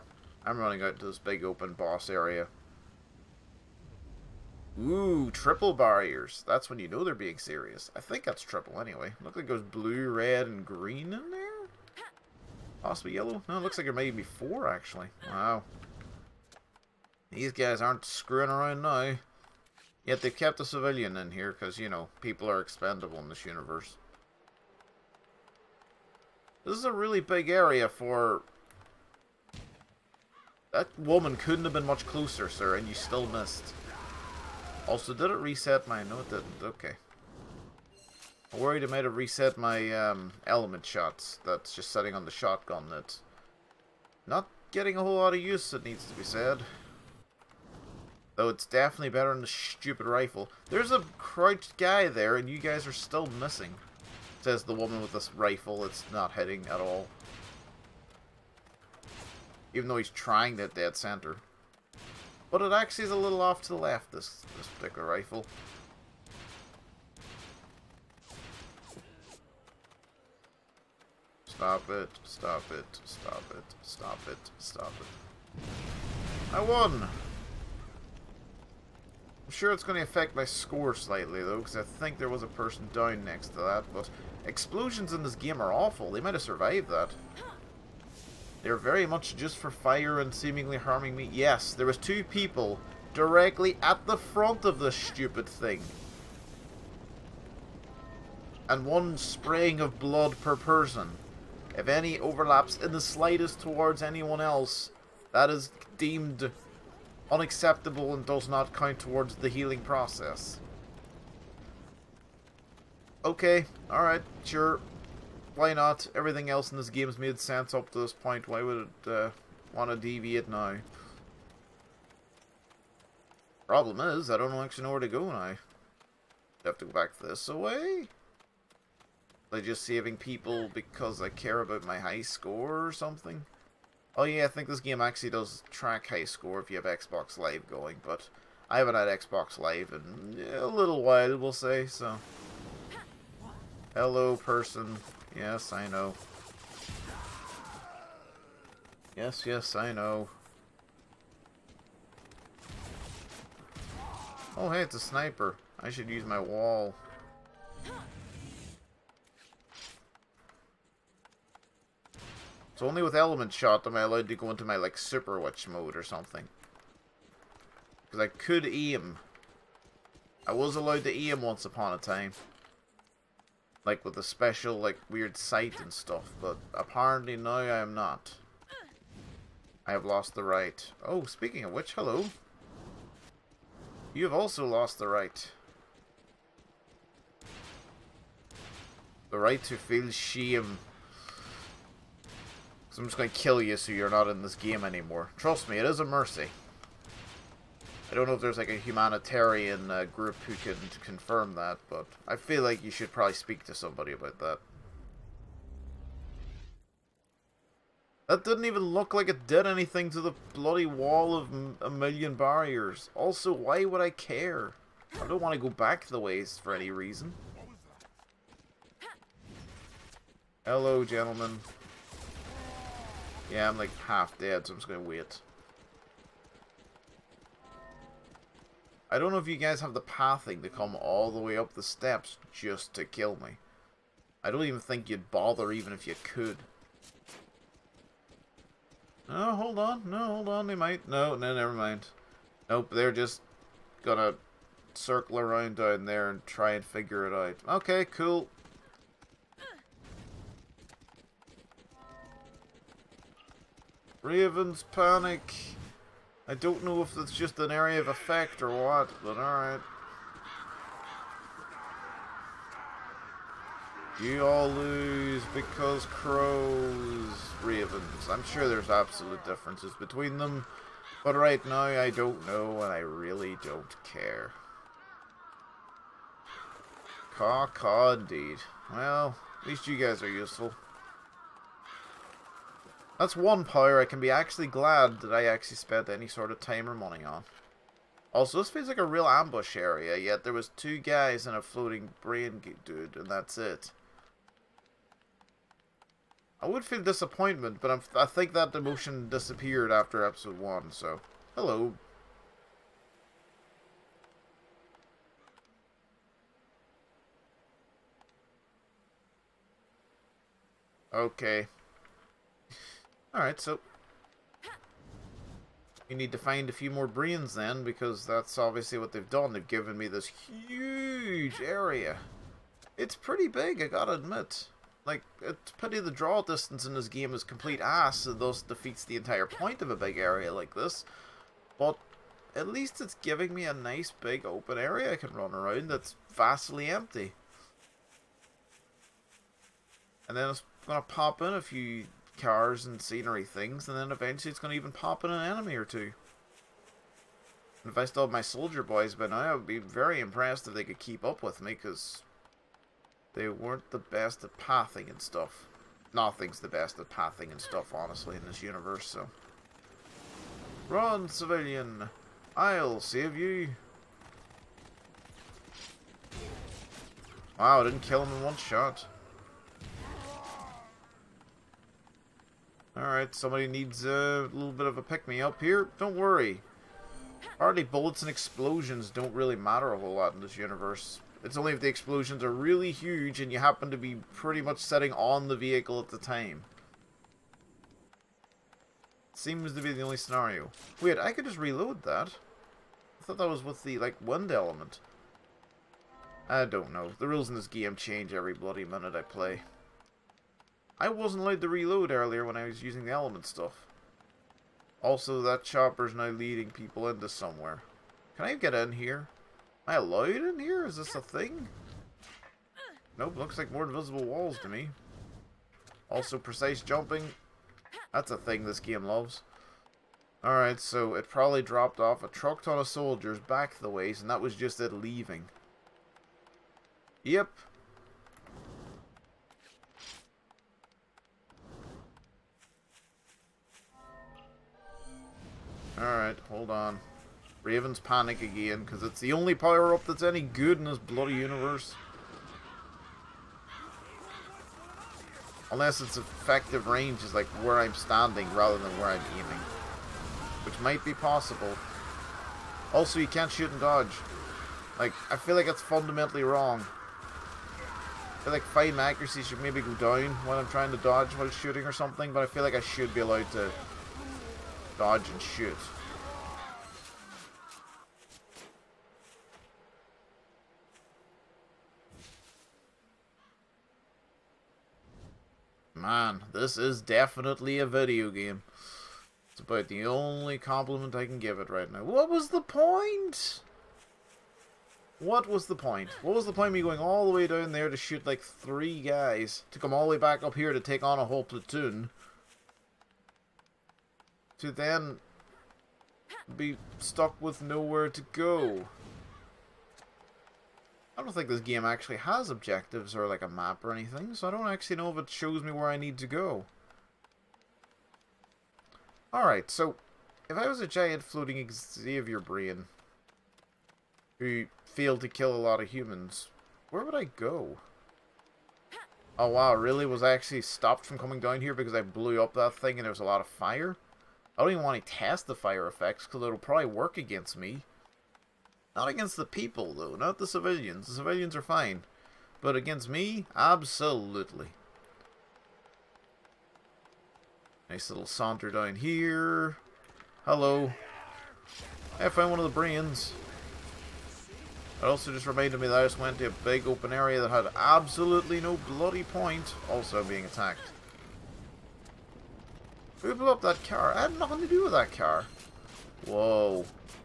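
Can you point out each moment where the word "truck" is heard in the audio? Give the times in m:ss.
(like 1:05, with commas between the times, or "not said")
7:02.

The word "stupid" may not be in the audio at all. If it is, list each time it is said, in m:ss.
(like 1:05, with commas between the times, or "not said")
0:49, 1:34.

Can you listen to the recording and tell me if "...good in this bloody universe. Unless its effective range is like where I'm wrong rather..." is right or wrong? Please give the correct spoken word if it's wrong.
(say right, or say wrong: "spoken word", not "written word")
wrong: "standing", not "wrong".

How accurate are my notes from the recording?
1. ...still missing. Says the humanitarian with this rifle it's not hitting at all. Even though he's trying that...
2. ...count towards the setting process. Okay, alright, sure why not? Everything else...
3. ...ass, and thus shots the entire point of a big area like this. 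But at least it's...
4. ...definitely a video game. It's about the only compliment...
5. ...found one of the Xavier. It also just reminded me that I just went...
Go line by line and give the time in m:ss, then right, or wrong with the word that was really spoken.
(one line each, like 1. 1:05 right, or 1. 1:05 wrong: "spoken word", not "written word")
1. 0:52 wrong: "woman", not "humanitarian"
2. 1:48 wrong: "healing", not "setting"
3. 5:27 wrong: "defeats", not "shots"
4. 7:57 right
5. 9:02 wrong: "Brains", not "Xavier".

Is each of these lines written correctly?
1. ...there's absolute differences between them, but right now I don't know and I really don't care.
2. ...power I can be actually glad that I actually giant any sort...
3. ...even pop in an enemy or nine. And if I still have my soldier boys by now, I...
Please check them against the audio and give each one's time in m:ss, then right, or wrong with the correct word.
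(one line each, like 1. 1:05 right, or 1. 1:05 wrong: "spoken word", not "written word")
1. 4:28 right
2. 4:43 wrong: "spent", not "giant"
3. 5:44 wrong: "two", not "nine".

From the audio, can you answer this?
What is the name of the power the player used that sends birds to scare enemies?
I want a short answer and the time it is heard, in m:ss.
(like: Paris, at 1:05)
Ravens panic, at 4:14.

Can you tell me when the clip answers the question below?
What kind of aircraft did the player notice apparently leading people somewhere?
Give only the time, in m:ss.
6:45.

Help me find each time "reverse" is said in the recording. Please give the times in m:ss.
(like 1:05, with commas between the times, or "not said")
not said.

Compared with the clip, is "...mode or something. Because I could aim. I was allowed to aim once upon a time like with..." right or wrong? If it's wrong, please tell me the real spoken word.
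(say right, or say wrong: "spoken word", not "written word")
right.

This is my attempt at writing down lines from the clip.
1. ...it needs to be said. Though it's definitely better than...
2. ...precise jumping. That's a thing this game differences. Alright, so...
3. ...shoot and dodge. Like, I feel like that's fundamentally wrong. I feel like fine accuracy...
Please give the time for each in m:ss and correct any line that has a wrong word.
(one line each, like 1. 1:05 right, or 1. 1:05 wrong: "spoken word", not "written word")
1. 0:45 right
2. 6:56 wrong: "loves", not "differences"
3. 7:33 right.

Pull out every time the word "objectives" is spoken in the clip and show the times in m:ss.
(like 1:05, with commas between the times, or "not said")
8:22.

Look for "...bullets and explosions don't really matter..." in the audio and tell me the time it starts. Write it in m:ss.
6:17.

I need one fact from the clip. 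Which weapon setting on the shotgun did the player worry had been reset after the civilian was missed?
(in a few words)
element shots.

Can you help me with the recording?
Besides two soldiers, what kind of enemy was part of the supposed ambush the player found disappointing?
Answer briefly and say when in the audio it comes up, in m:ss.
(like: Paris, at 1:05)
floating brain dude, at 4:51.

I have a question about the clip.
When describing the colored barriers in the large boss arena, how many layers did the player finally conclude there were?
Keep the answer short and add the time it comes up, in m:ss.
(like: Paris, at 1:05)
4, at 0:14.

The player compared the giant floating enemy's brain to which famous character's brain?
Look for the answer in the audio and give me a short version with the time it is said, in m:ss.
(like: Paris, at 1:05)
Xavier, at 8:31.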